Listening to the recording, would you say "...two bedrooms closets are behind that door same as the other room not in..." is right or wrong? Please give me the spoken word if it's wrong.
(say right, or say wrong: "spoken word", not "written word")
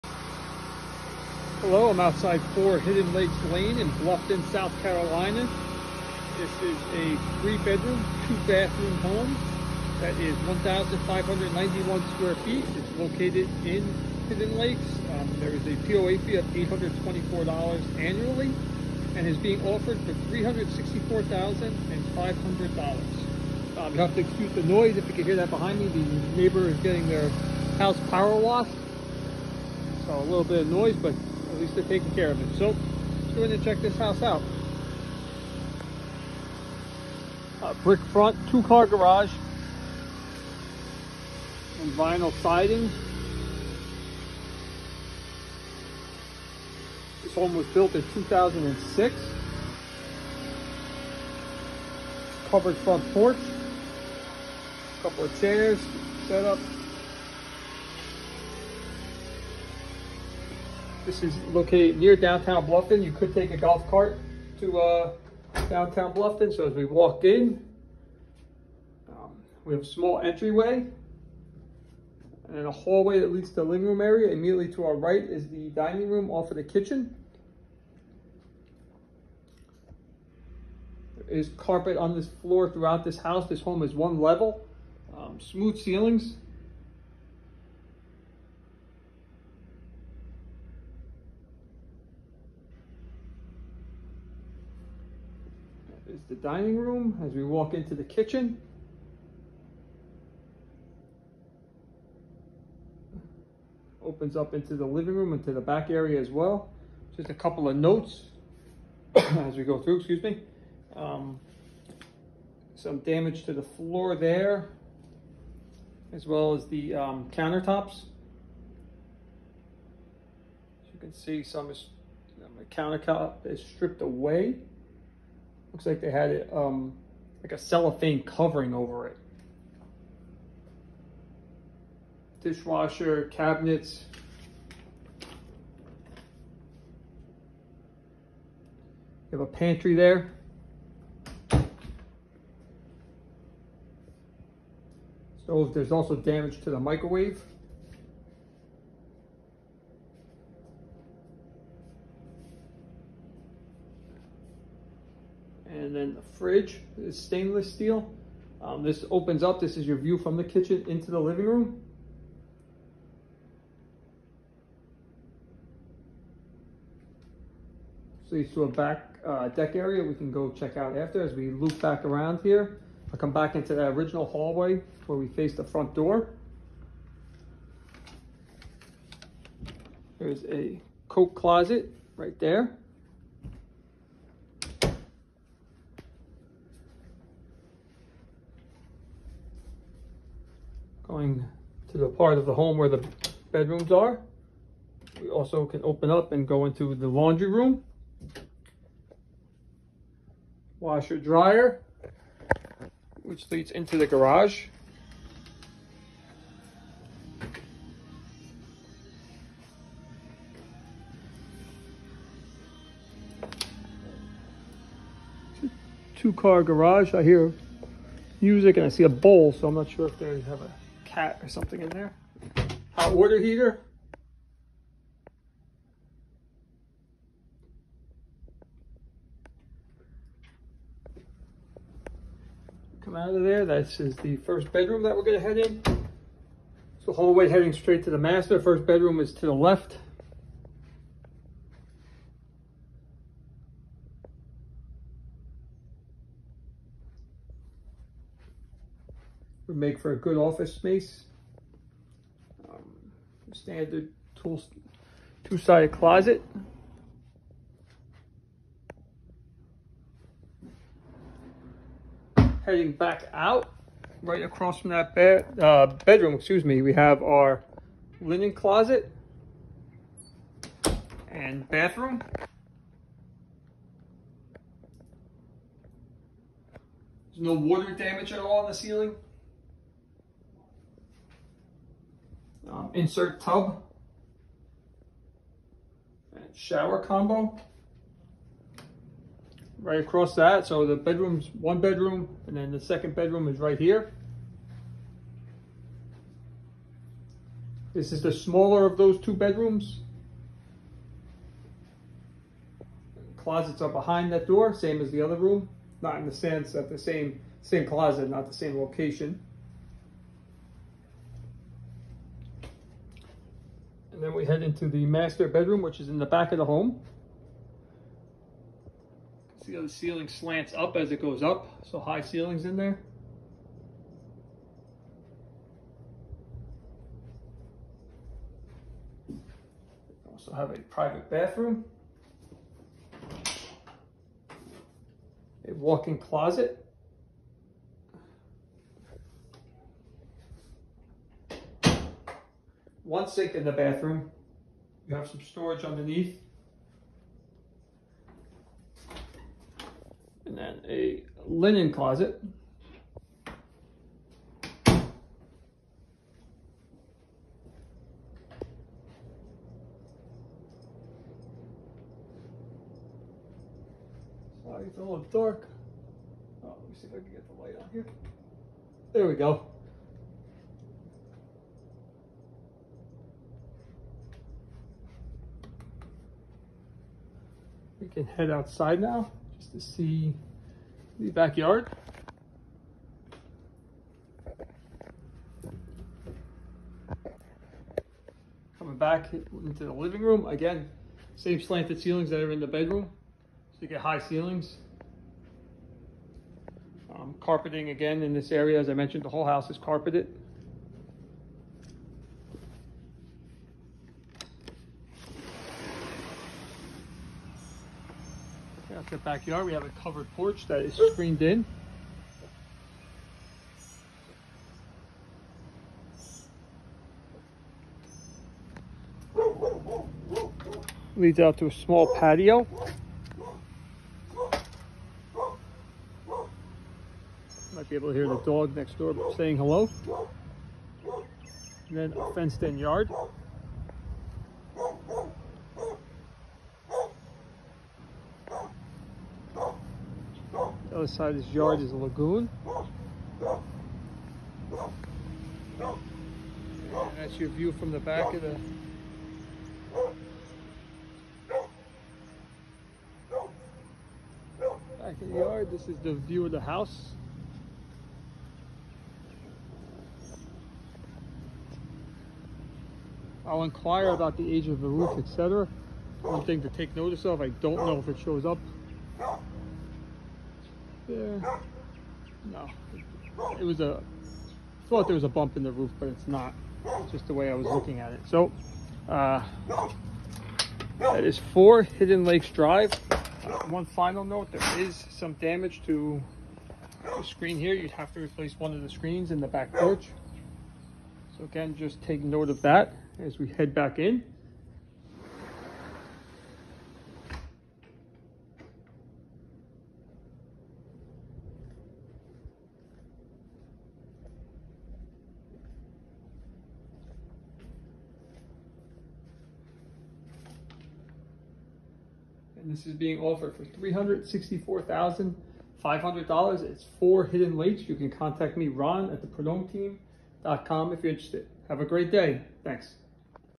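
right.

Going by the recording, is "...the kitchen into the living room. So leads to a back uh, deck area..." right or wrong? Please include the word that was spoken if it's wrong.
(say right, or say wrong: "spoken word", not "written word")
right.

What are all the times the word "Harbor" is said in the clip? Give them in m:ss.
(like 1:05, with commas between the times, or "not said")
not said.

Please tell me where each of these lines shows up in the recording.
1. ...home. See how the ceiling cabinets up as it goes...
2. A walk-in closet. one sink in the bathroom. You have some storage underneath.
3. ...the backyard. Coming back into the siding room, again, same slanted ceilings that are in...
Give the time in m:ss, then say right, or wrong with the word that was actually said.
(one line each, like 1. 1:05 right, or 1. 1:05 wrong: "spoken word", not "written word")
1. 5:16 wrong: "slants", not "cabinets"
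2. 5:35 right
3. 6:21 wrong: "living", not "siding".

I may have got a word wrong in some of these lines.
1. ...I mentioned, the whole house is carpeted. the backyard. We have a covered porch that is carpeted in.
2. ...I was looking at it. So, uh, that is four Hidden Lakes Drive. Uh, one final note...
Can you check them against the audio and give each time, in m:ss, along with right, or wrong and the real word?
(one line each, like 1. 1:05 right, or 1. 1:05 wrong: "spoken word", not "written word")
1. 6:38 wrong: "screened", not "carpeted"
2. 7:57 right.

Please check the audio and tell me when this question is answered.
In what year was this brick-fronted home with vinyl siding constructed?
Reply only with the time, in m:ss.
0:48.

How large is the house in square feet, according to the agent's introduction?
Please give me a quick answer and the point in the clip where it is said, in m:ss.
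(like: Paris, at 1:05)
1,591, at 0:10.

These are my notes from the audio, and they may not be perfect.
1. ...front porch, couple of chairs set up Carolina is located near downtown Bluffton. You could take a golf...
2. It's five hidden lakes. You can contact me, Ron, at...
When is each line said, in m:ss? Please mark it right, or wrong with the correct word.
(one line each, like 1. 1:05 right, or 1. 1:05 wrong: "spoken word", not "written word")
1. 0:52 wrong: "This", not "Carolina"
2. 8:36 wrong: "four", not "five".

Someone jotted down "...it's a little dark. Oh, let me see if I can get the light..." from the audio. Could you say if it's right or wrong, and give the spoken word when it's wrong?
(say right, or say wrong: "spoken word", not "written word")
right.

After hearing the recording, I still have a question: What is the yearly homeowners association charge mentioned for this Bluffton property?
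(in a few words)
$824.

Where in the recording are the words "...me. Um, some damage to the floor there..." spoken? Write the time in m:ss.
1:50.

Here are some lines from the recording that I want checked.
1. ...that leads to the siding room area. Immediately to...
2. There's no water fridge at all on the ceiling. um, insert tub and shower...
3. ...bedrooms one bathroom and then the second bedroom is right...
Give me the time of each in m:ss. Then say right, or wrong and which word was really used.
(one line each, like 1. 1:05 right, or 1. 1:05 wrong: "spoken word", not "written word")
1. 1:13 wrong: "living", not "siding"
2. 4:37 wrong: "damage", not "fridge"
3. 4:50 wrong: "bedroom", not "bathroom".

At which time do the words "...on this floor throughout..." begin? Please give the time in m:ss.
1:21.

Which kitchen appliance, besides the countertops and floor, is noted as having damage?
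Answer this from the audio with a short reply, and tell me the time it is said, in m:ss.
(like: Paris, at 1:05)
microwave, at 2:26.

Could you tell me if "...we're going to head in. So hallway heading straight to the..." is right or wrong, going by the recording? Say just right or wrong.
right.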